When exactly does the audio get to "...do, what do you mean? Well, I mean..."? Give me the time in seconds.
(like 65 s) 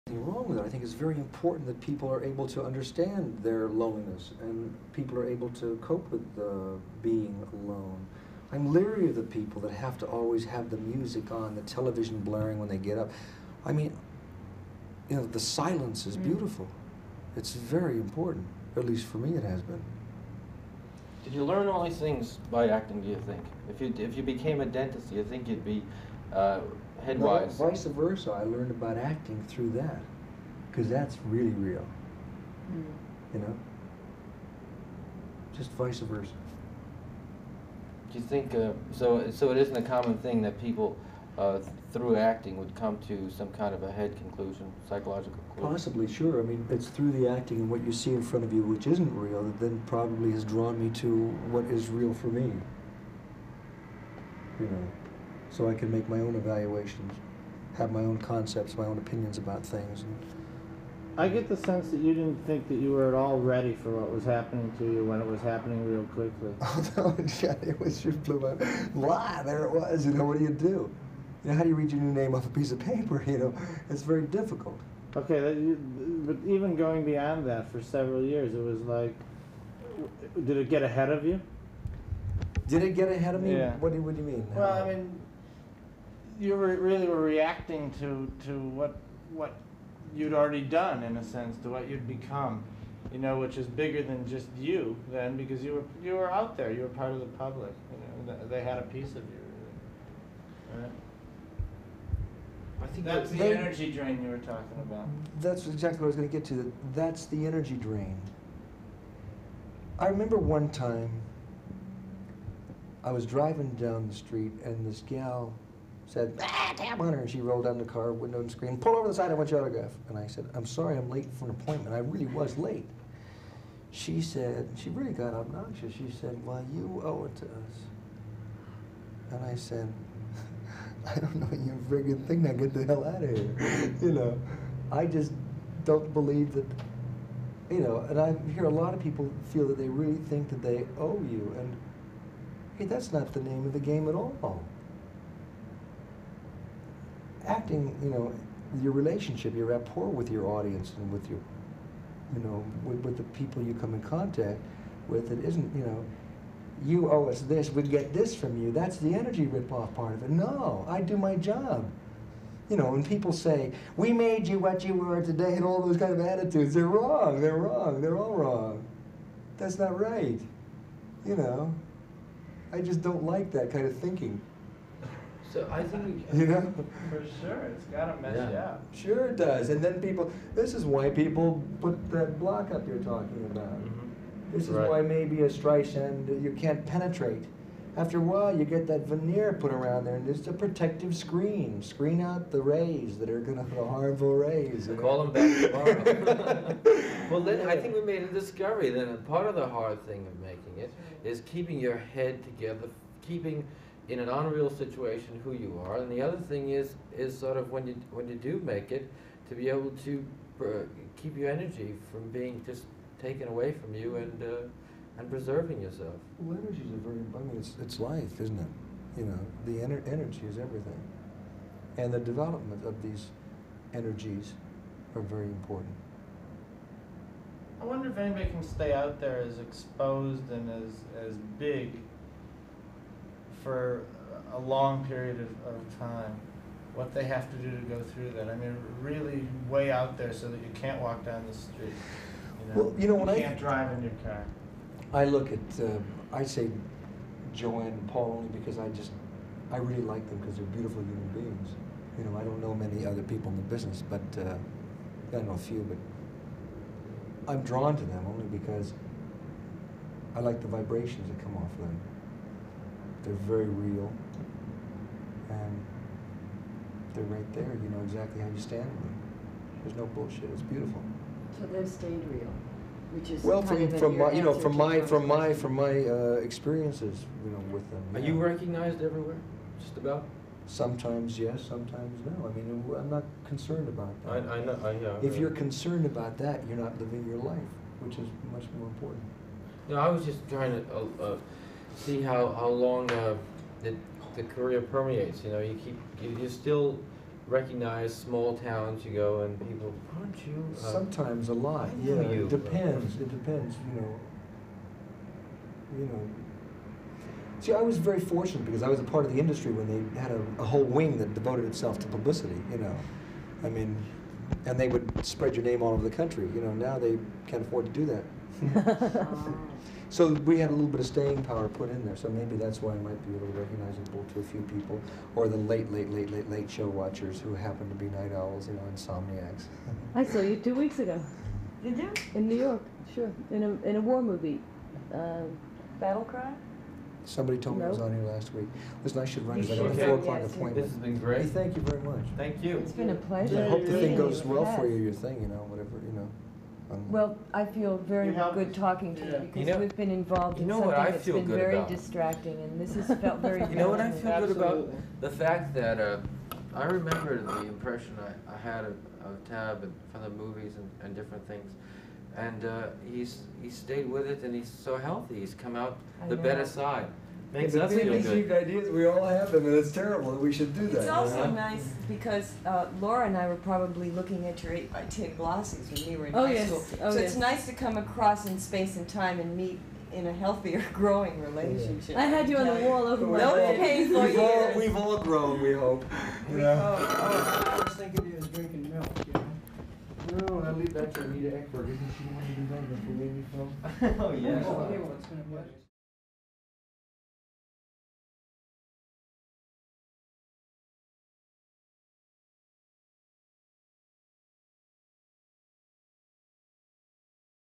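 83 s.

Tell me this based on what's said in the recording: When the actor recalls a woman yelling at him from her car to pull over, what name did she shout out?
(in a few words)
Tab Hunter.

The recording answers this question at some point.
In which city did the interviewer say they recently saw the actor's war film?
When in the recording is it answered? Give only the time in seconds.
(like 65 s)
332 s.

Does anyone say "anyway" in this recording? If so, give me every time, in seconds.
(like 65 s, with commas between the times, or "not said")
394 s.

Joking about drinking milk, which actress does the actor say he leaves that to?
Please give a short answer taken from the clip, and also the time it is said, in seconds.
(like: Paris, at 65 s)
Anita Ekberg, at 391 s.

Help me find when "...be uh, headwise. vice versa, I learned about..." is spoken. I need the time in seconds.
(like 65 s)
25 s.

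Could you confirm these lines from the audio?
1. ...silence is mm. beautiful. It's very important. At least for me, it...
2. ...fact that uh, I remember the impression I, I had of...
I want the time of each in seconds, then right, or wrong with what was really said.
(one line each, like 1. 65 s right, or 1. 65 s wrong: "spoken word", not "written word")
1. 15 s right
2. 355 s right.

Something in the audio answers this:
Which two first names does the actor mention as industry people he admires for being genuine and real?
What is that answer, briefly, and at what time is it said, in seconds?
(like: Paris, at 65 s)
Joanne and Paul, at 247 s.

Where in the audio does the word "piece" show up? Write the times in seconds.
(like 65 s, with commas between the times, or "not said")
72 s, 98 s.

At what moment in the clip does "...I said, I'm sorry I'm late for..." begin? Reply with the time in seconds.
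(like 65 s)
120 s.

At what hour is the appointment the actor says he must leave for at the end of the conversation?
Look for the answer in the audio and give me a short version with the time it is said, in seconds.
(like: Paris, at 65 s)
4 o'clock, at 340 s.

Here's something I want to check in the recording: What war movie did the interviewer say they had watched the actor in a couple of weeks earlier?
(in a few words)
Battle Cry.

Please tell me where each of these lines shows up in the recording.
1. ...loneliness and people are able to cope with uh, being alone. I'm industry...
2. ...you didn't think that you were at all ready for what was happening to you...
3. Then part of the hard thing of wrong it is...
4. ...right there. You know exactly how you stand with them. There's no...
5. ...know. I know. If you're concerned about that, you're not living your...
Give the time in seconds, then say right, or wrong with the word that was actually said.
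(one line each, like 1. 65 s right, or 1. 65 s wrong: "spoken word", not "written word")
1. 3 s wrong: "leery", not "industry"
2. 61 s right
3. 198 s wrong: "making", not "wrong"
4. 267 s right
5. 284 s right.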